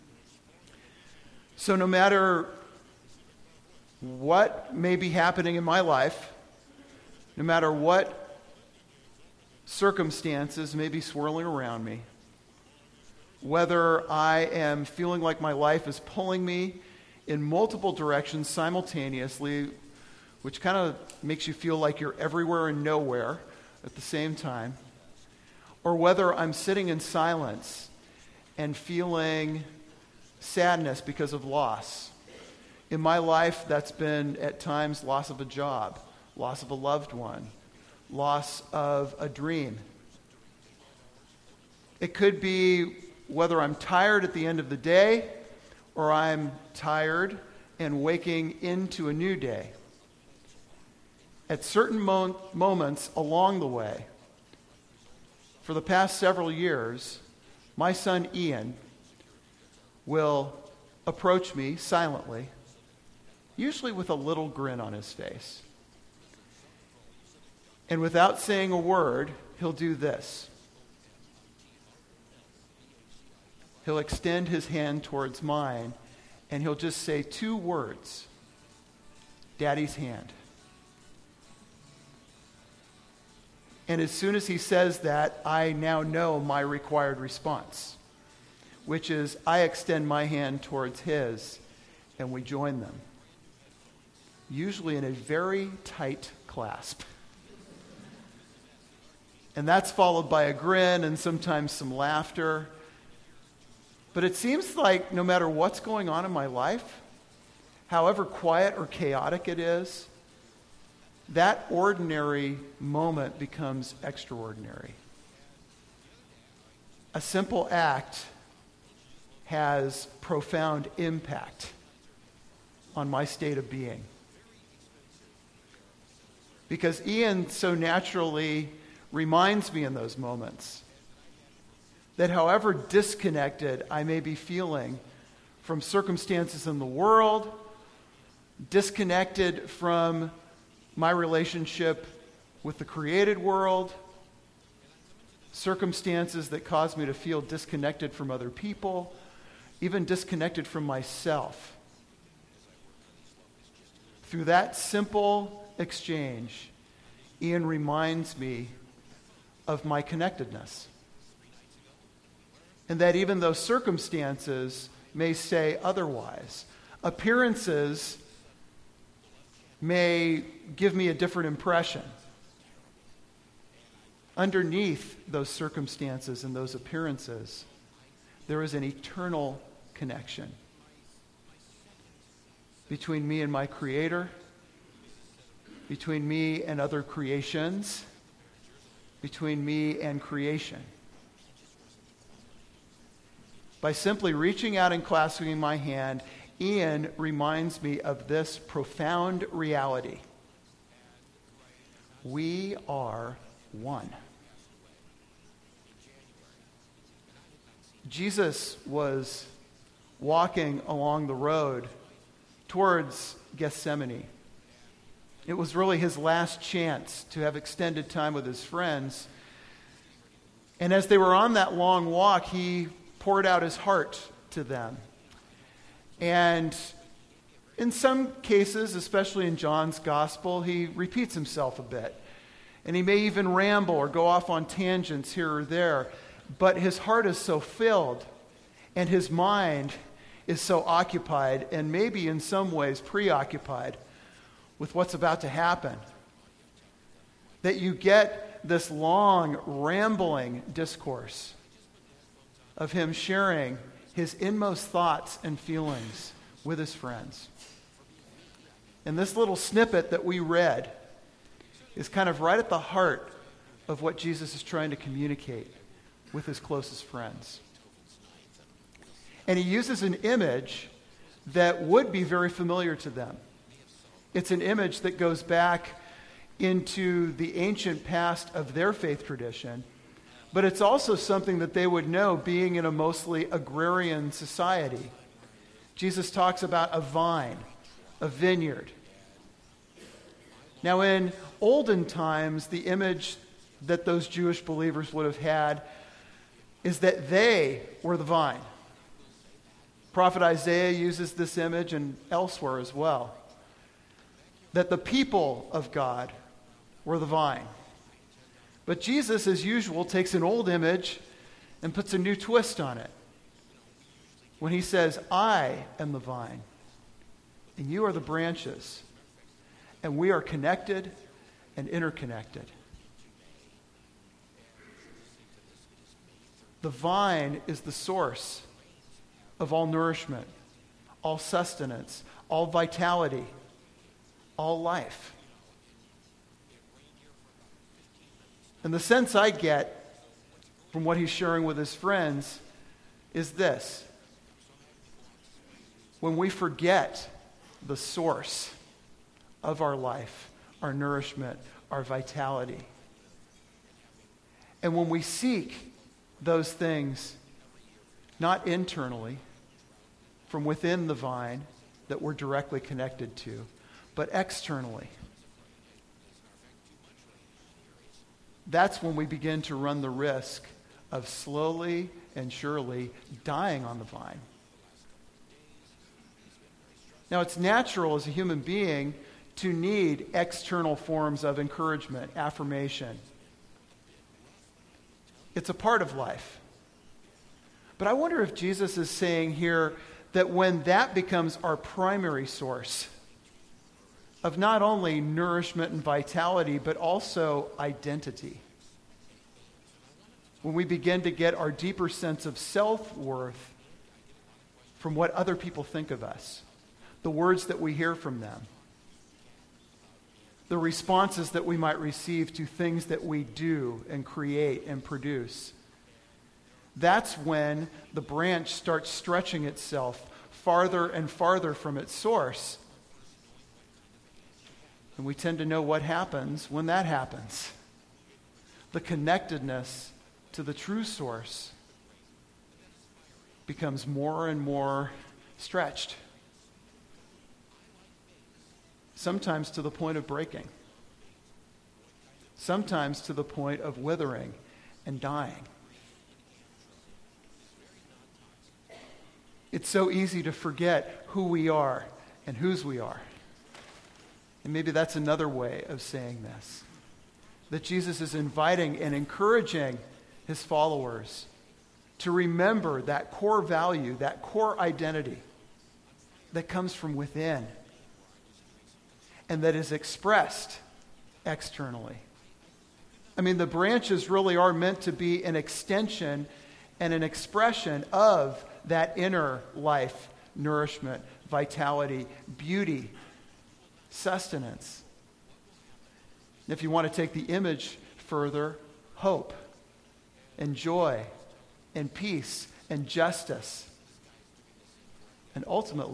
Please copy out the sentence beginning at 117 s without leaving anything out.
A simple act has profound impact on my state of being.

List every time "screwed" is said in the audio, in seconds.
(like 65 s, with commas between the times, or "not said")
not said.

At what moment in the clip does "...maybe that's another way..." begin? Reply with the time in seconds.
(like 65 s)
454 s.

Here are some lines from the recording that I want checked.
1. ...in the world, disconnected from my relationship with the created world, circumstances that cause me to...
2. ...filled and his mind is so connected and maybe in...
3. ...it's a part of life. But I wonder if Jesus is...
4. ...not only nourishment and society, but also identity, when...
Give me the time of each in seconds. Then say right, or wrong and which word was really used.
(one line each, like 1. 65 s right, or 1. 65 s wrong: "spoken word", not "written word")
1. 136 s right
2. 237 s wrong: "occupied", not "connected"
3. 385 s right
4. 394 s wrong: "vitality", not "society".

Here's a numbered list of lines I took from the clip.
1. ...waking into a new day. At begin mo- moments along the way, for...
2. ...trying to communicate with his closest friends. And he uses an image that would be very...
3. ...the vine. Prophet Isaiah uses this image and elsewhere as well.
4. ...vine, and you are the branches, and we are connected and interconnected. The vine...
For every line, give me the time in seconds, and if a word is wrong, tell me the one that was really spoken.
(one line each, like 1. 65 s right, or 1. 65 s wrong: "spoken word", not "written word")
1. 48 s wrong: "certain", not "begin"
2. 264 s right
3. 298 s right
4. 316 s right.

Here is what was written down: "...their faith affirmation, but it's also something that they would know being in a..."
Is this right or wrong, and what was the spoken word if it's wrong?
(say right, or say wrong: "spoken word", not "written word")
wrong: "tradition", not "affirmation".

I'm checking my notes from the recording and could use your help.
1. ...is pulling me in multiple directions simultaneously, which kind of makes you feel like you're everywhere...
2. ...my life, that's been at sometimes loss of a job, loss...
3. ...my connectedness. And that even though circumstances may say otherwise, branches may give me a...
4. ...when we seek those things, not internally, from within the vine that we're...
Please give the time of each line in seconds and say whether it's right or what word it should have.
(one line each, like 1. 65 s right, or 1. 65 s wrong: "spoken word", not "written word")
1. 15 s right
2. 33 s wrong: "times", not "sometimes"
3. 159 s wrong: "appearances", not "branches"
4. 354 s right.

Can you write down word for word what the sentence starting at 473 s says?
I mean, the branches really are meant to be an extension and an expression of that inner life, nourishment, vitality, beauty, sustenance.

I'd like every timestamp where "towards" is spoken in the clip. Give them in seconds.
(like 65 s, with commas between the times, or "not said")
75 s, 90 s, 212 s.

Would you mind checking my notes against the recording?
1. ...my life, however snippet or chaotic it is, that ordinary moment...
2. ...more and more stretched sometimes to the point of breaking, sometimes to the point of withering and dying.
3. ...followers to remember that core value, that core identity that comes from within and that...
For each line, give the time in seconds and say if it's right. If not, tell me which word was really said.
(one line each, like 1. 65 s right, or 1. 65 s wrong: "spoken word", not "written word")
1. 106 s wrong: "quiet", not "snippet"
2. 434 s right
3. 460 s right.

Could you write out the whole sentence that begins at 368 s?
That's when we begin to run the risk of slowly and surely dying on the vine.